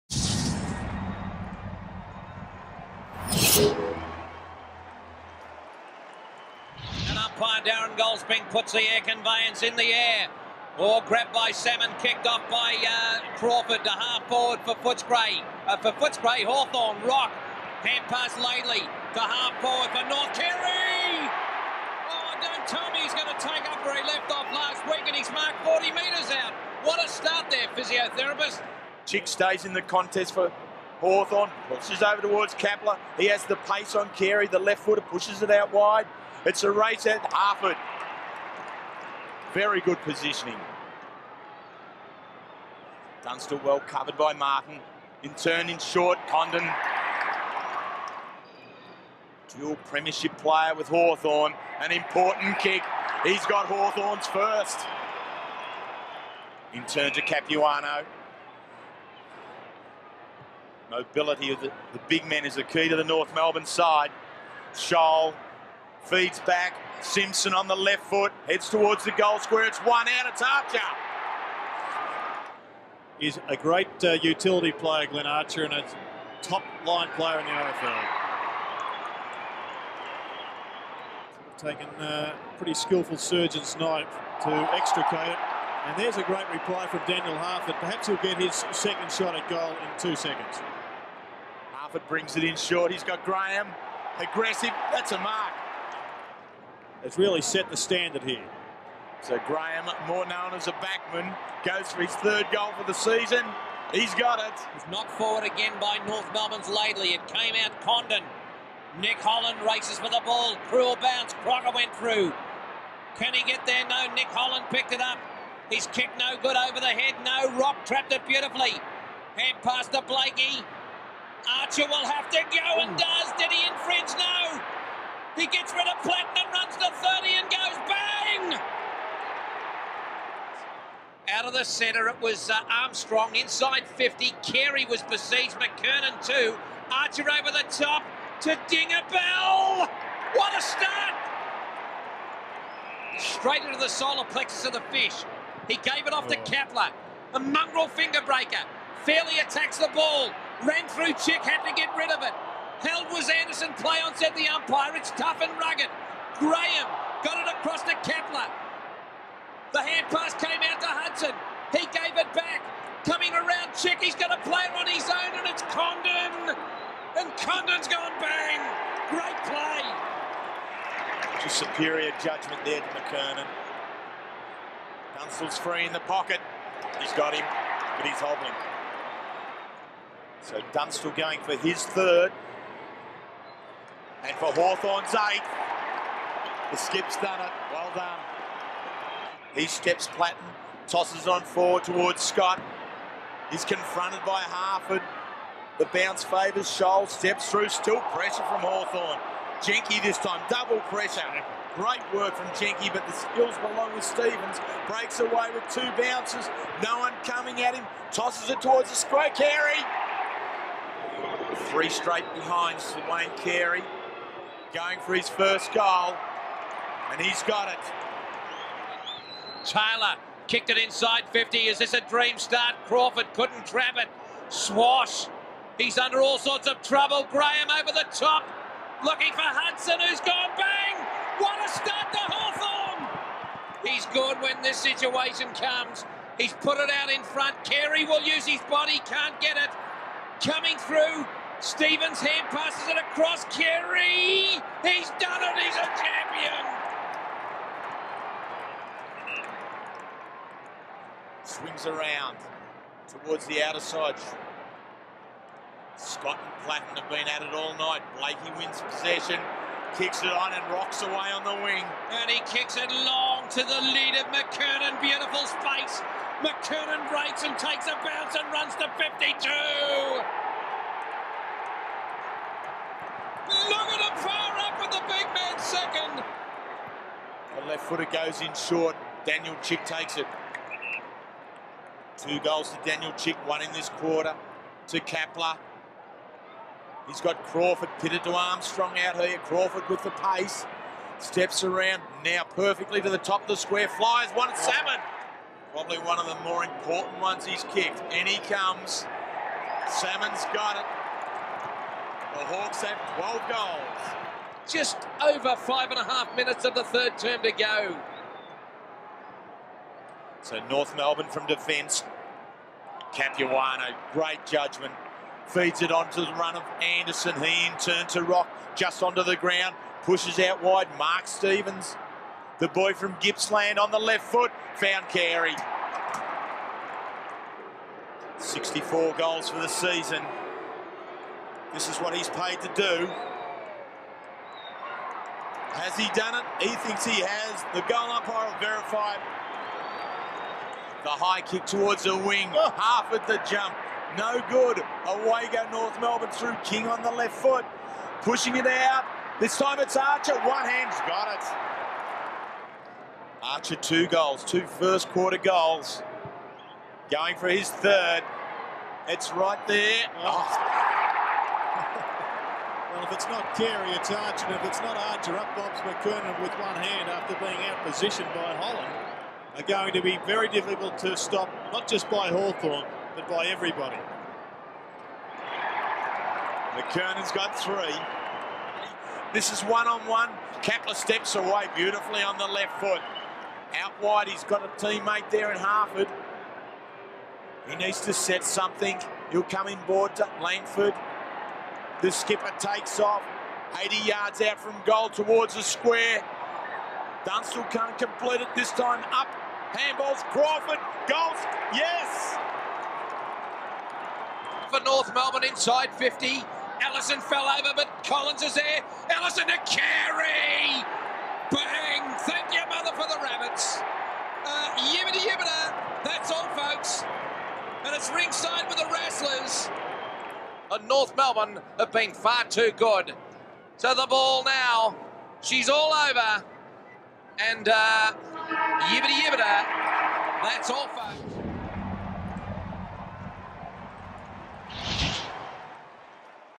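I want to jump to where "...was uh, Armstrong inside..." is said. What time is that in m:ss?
2:12.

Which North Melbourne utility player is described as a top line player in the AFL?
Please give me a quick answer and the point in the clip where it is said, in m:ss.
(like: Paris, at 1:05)
Glenn Archer, at 1:15.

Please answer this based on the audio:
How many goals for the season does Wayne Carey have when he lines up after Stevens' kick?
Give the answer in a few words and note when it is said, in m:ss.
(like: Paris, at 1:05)
64, at 5:28.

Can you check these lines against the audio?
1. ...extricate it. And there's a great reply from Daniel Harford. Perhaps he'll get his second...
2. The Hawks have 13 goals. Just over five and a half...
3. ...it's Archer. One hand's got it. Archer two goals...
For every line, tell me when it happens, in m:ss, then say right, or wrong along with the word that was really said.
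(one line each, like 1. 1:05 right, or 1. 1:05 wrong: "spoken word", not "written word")
1. 1:24 right
2. 5:02 wrong: "12", not "13"
3. 5:49 right.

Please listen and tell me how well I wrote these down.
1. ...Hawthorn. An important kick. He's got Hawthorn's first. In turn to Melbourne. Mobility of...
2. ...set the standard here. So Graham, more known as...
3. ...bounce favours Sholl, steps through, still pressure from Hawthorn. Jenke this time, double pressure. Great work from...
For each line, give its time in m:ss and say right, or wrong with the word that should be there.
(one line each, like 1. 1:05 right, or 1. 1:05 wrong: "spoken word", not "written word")
1. 0:50 wrong: "Capuano", not "Melbourne"
2. 1:37 right
3. 3:15 right.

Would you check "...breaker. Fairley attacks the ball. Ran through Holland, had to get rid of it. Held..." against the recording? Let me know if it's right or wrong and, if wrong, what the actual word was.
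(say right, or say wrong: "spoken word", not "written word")
wrong: "Chick", not "Holland".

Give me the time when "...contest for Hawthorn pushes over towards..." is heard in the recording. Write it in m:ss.
0:29.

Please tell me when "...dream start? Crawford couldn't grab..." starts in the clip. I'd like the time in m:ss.
3:42.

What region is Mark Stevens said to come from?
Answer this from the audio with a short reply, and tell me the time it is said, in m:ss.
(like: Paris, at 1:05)
Gippsland, at 5:23.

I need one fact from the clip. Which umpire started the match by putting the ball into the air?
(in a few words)
Darren Goldspink.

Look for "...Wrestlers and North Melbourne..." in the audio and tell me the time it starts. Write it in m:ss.
6:58.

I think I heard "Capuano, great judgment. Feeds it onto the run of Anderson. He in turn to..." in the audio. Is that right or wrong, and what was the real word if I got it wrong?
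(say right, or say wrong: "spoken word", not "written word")
right.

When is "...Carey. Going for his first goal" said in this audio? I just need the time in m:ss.
3:33.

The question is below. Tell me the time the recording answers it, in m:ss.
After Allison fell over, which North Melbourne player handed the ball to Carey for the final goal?
6:48.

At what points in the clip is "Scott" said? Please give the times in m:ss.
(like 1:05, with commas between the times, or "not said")
3:12, 4:15.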